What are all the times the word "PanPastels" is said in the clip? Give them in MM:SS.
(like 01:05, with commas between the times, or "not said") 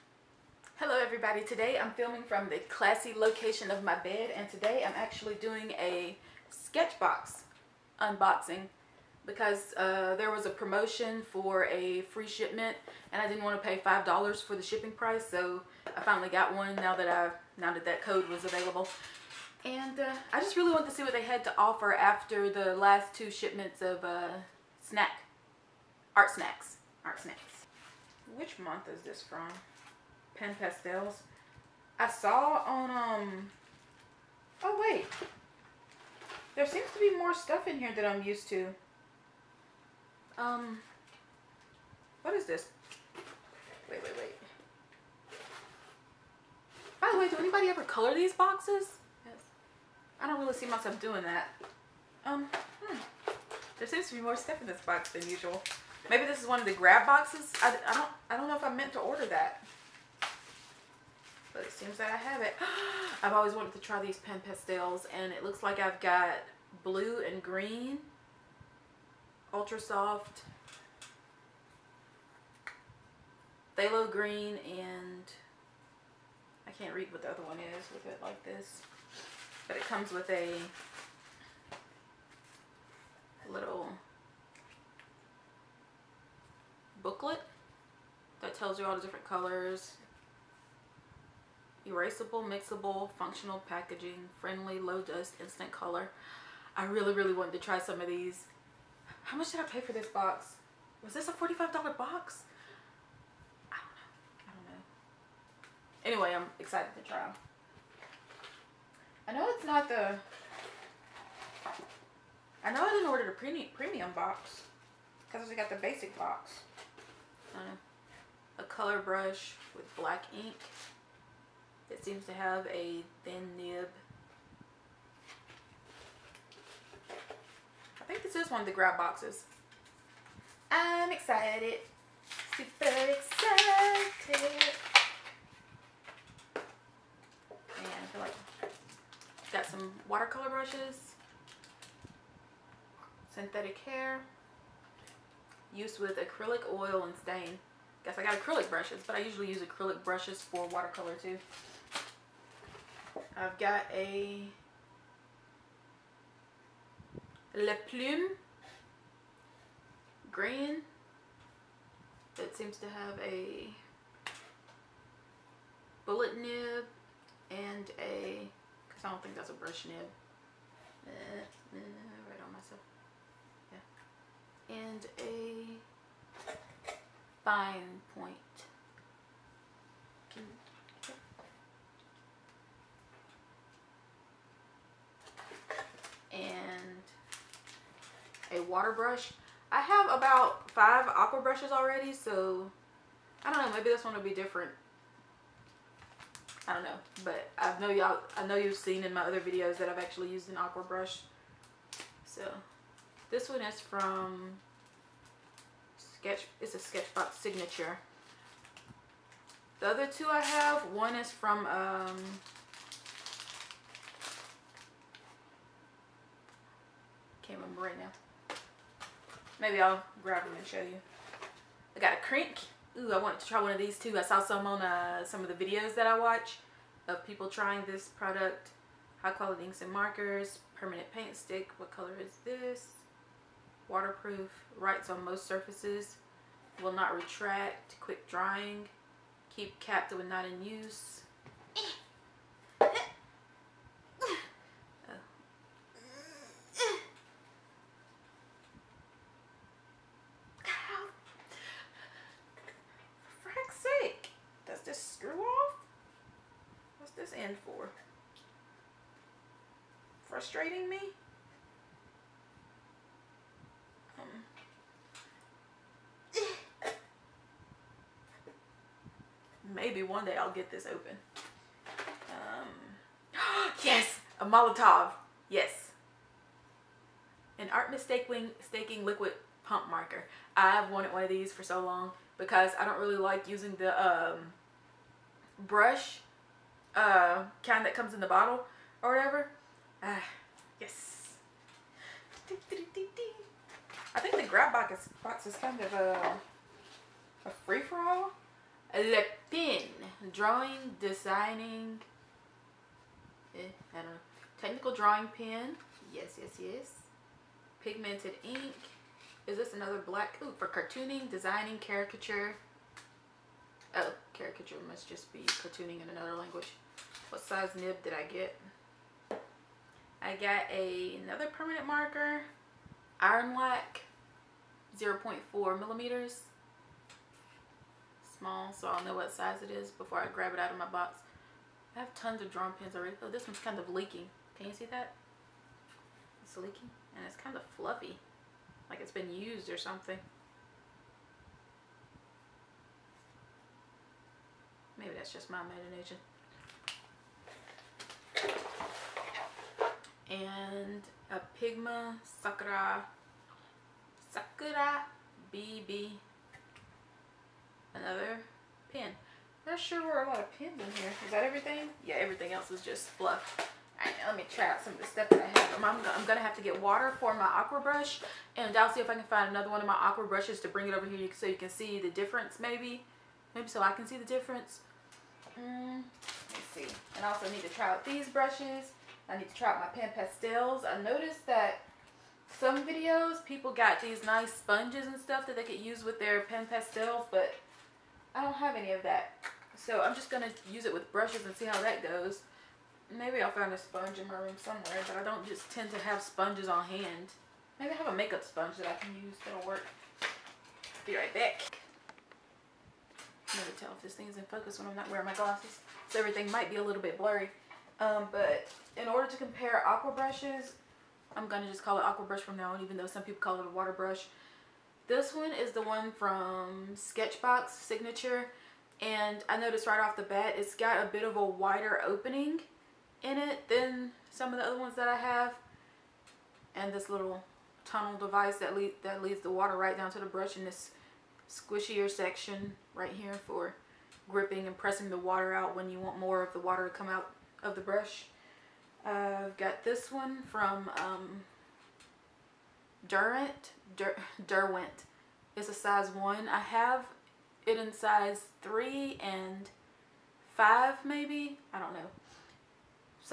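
00:30, 01:04, 06:20, 06:26.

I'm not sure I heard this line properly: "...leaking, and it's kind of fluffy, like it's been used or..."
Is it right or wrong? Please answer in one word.
right.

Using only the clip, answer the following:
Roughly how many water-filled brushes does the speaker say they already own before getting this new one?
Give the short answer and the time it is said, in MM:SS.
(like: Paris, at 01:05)
5, at 03:10.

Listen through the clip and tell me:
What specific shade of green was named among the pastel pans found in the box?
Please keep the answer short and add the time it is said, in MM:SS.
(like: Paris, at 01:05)
phthalo green, at 01:13.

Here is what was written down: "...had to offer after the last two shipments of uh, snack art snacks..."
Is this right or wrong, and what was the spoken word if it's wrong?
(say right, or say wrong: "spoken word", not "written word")
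right.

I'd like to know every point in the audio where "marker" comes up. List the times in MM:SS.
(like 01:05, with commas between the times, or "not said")
03:49, 04:39, 05:21.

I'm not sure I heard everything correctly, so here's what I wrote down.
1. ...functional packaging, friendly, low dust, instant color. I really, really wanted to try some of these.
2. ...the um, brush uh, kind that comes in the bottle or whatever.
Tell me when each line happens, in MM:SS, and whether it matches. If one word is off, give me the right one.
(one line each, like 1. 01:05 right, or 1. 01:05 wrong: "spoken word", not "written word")
1. 01:33 right
2. 04:43 right.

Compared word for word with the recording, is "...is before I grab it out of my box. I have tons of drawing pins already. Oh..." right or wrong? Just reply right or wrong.
right.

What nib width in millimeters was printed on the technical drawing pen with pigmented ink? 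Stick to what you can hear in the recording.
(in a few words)
0.4 millimeters.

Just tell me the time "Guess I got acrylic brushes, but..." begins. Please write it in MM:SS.
02:28.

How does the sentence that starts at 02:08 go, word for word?
I think this is one of the grab boxes.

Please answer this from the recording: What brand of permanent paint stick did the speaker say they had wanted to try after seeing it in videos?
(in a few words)
Krink.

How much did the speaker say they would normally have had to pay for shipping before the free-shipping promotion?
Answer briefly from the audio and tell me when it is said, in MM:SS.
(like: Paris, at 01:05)
$5, at 00:13.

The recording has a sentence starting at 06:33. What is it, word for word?
Maybe I'll find a sponge in my room somewhere, but I don't just tend to have sponges on hand.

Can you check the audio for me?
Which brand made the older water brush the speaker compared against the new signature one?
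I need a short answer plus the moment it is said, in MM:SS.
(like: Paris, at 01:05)
Derwent, at 07:24.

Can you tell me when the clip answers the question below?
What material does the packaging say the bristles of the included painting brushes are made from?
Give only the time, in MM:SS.
02:23.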